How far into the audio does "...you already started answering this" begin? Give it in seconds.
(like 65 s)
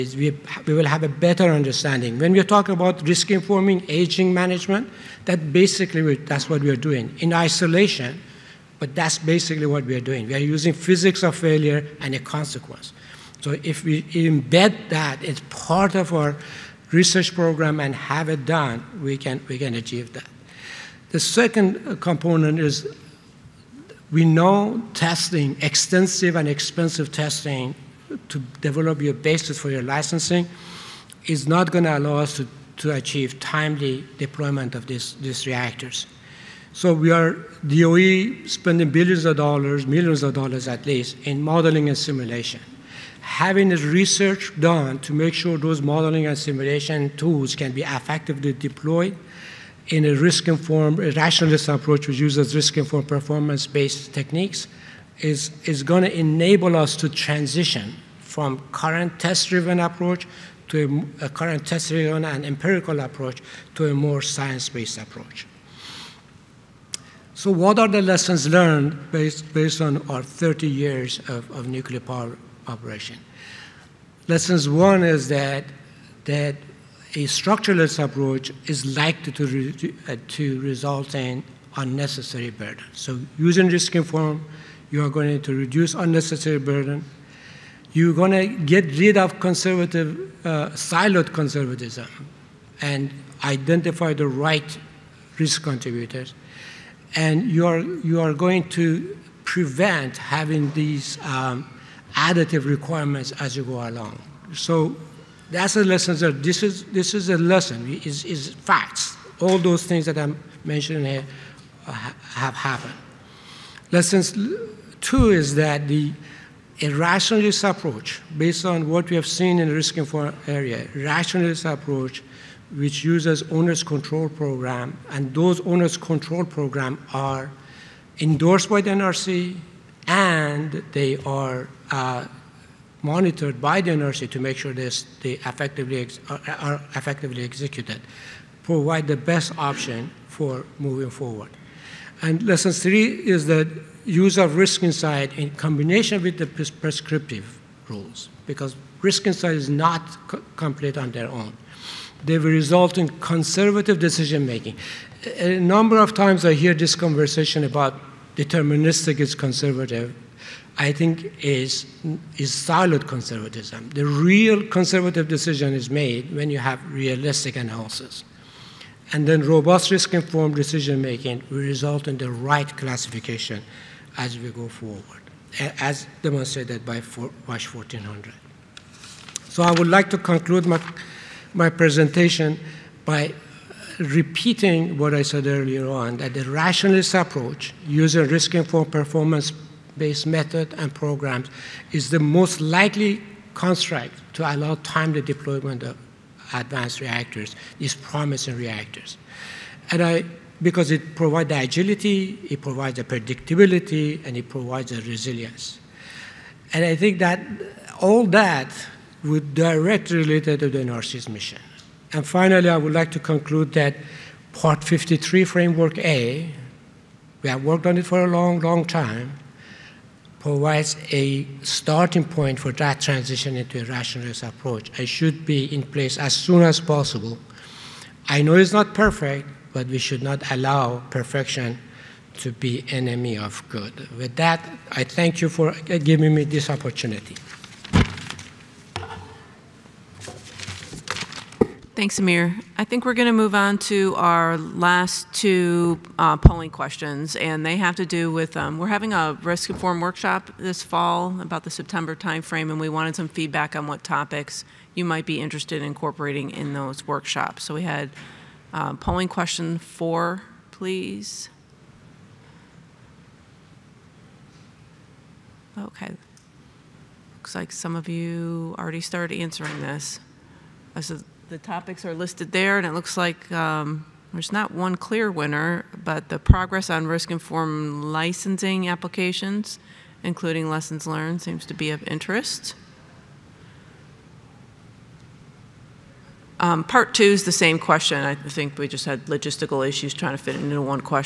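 268 s.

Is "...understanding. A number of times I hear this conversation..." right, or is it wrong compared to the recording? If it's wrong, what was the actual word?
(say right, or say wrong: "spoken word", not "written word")
wrong: "making", not "understanding".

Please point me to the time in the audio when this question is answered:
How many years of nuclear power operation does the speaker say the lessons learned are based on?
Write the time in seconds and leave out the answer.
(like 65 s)
70 s.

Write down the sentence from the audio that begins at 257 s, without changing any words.
So we had uh, polling question four, please.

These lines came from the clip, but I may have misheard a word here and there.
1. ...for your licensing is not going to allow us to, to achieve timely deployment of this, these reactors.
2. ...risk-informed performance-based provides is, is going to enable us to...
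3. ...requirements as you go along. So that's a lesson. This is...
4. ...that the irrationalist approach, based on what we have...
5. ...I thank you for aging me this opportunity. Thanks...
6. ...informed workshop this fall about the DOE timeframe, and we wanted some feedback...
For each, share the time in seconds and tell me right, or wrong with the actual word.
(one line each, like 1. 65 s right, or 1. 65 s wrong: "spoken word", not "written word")
1. 29 s right
2. 52 s wrong: "techniques", not "provides"
3. 102 s right
4. 115 s right
5. 234 s wrong: "giving", not "aging"
6. 249 s wrong: "September", not "DOE".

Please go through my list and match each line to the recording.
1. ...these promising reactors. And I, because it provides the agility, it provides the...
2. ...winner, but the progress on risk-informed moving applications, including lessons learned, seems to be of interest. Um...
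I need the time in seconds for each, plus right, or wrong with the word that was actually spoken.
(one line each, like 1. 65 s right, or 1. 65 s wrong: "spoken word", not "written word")
1. 197 s right
2. 275 s wrong: "licensing", not "moving".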